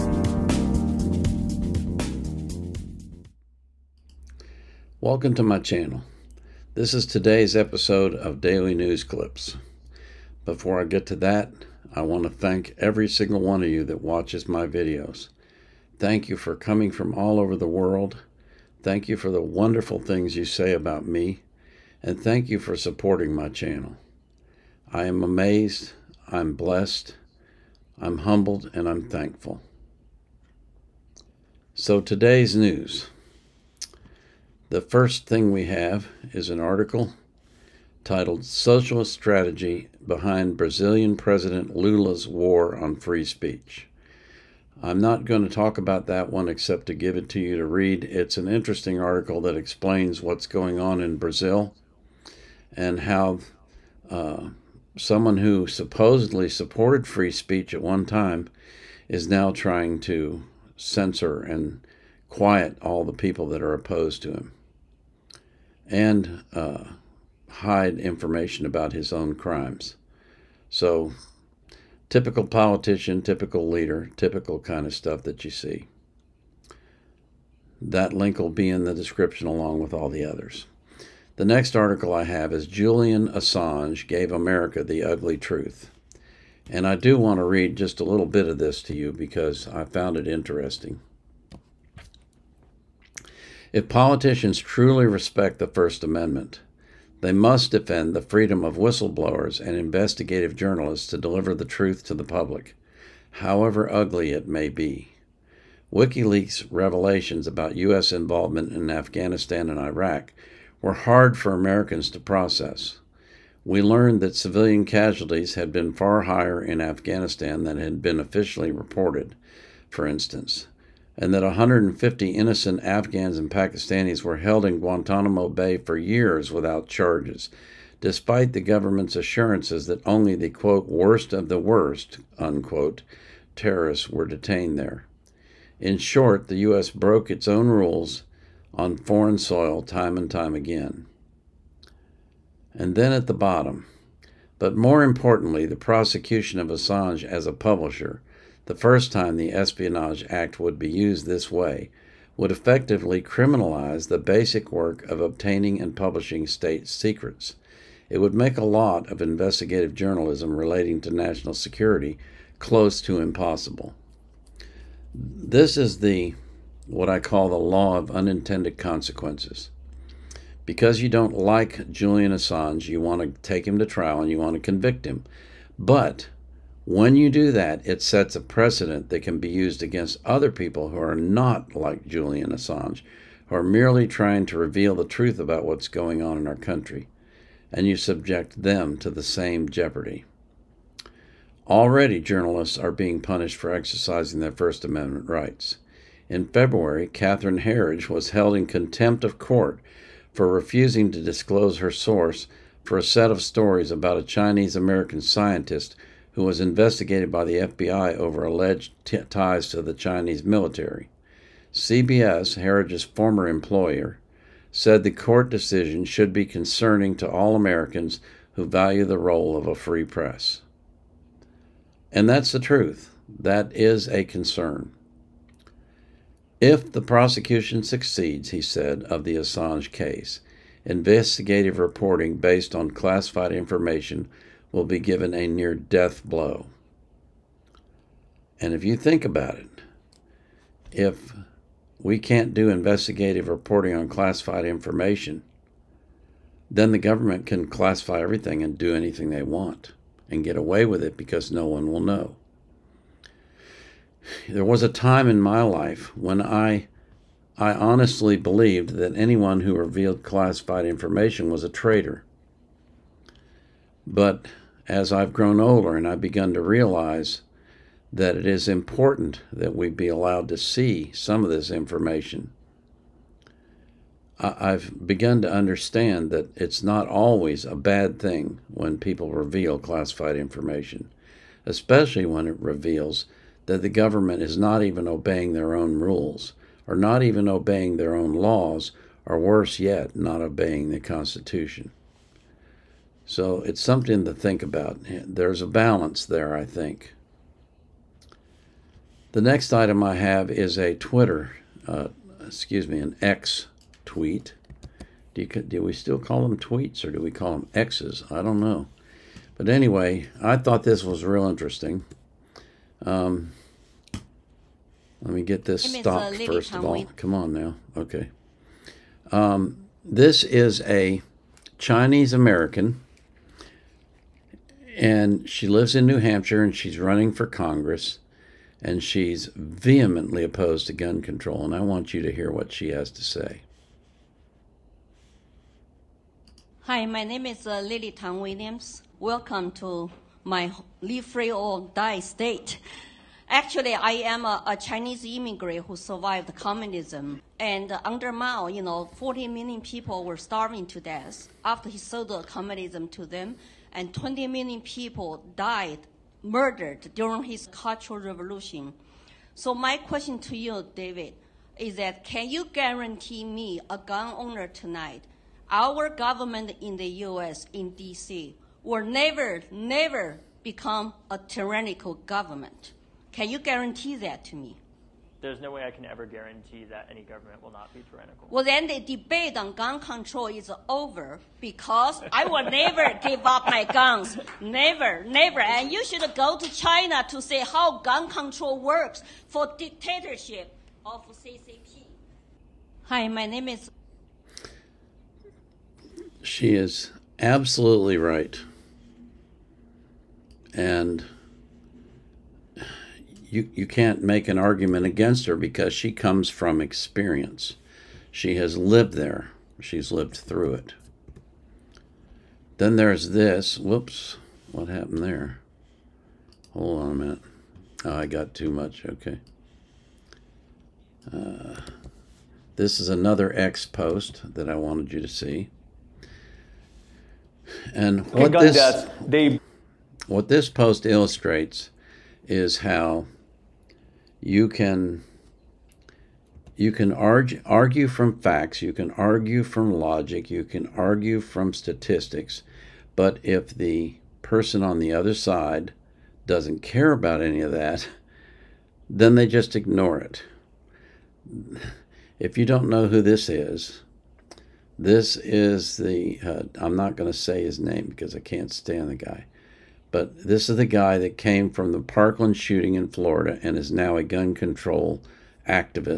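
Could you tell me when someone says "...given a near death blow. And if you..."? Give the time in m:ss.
3:54.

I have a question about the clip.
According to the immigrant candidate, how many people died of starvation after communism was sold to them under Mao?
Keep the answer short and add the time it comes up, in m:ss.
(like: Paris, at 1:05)
40 million, at 5:49.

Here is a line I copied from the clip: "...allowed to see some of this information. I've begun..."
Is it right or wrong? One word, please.
right.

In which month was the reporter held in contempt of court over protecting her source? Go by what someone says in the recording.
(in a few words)
February.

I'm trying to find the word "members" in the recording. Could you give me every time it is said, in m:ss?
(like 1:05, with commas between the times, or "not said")
not said.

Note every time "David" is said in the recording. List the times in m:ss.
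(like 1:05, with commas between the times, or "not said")
6:00.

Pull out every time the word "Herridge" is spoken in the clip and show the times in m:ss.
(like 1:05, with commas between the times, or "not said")
3:17, 3:32.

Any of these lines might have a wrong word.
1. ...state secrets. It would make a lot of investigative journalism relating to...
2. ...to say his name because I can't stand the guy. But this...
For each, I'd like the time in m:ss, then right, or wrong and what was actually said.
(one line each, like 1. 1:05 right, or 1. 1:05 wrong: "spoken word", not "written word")
1. 2:36 right
2. 7:37 right.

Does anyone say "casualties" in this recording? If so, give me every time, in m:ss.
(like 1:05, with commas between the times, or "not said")
1:54.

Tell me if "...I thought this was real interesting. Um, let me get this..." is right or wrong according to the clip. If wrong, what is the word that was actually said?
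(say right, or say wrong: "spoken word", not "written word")
right.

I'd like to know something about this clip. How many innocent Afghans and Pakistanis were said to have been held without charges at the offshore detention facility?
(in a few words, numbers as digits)
150.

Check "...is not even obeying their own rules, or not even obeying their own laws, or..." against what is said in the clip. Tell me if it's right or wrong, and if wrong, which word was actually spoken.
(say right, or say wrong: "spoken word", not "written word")
right.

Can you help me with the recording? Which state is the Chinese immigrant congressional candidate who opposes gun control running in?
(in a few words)
New Hampshire.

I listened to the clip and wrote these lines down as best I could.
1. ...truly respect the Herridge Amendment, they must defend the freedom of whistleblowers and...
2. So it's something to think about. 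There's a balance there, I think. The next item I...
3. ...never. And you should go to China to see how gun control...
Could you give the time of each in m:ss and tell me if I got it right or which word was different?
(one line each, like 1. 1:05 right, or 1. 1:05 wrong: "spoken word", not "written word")
1. 1:34 wrong: "First", not "Herridge"
2. 4:53 right
3. 6:25 right.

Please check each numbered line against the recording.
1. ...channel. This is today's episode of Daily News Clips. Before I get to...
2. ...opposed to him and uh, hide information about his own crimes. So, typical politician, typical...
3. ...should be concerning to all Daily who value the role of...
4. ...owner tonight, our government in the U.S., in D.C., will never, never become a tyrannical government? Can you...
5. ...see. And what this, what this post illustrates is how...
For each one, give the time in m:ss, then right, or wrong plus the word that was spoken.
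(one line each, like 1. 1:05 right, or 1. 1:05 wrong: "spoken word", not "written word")
1. 0:05 right
2. 1:03 right
3. 3:36 wrong: "Americans", not "Daily"
4. 6:04 right
5. 7:05 right.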